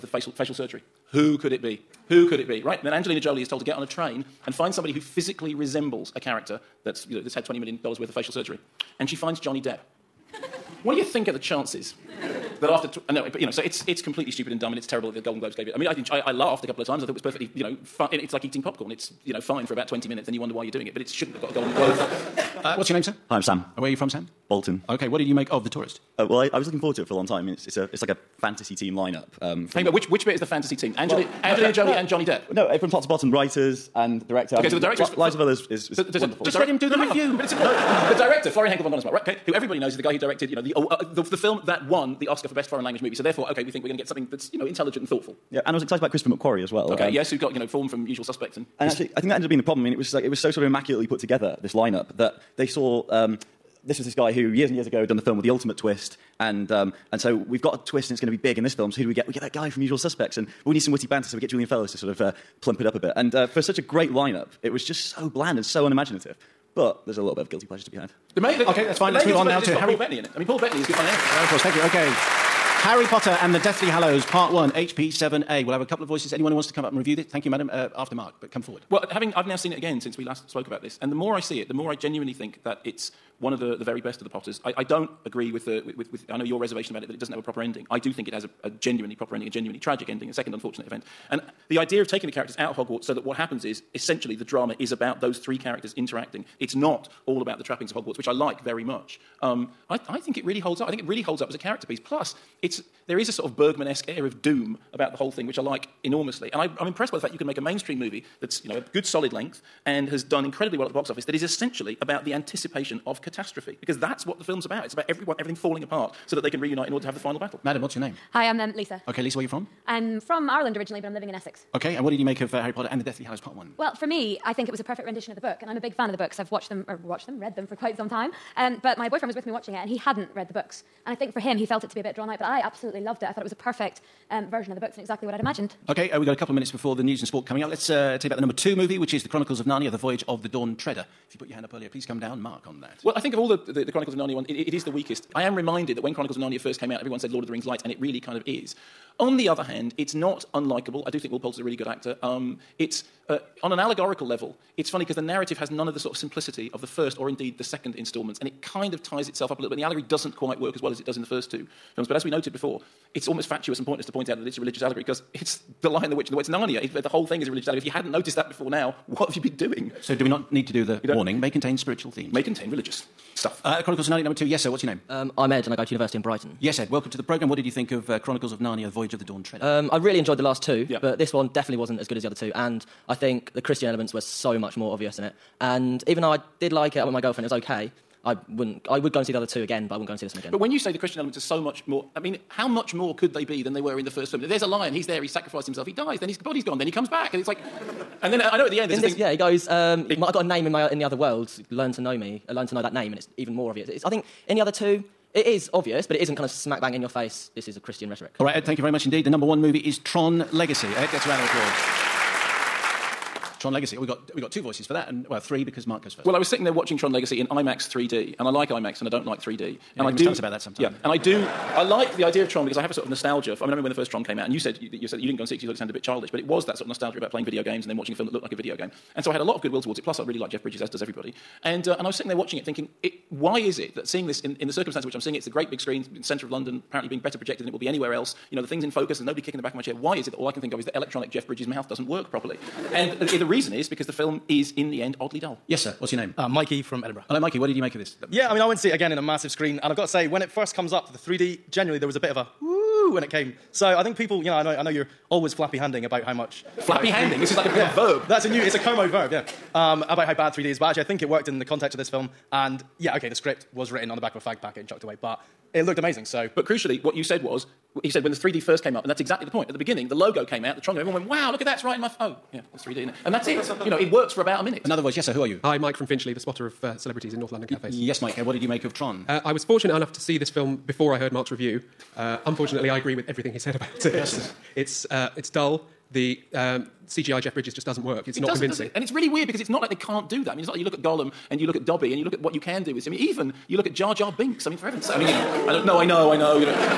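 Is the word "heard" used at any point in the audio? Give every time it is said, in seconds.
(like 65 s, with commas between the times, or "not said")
281 s.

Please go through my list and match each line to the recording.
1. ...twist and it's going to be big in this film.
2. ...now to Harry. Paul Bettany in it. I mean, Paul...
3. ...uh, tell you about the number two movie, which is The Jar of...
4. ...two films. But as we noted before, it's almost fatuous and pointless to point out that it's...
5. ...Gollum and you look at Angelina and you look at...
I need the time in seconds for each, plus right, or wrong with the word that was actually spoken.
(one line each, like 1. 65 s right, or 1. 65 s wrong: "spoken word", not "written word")
1. 57 s right
2. 69 s right
3. 137 s wrong: "Chronicles", not "Jar"
4. 161 s right
5. 291 s wrong: "Dobby", not "Angelina".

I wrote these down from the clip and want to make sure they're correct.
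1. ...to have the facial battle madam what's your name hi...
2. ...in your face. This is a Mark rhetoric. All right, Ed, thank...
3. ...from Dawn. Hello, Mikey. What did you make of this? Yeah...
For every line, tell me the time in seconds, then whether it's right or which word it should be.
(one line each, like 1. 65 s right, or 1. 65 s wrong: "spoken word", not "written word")
1. 117 s wrong: "final", not "facial"
2. 206 s wrong: "Christian", not "Mark"
3. 246 s wrong: "Edinburgh", not "Dawn".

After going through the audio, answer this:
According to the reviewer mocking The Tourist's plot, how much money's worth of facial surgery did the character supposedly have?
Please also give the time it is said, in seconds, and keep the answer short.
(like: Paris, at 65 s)
$20 million, at 7 s.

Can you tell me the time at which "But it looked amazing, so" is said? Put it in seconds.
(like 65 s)
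265 s.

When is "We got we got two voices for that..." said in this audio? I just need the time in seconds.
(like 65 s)
213 s.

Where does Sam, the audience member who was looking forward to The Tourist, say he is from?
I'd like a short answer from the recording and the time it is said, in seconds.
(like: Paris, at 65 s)
Bolton, at 24 s.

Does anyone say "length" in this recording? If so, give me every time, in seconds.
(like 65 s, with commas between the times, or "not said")
109 s.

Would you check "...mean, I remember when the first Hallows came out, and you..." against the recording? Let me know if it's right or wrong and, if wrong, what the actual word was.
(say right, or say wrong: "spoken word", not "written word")
wrong: "Tron", not "Hallows".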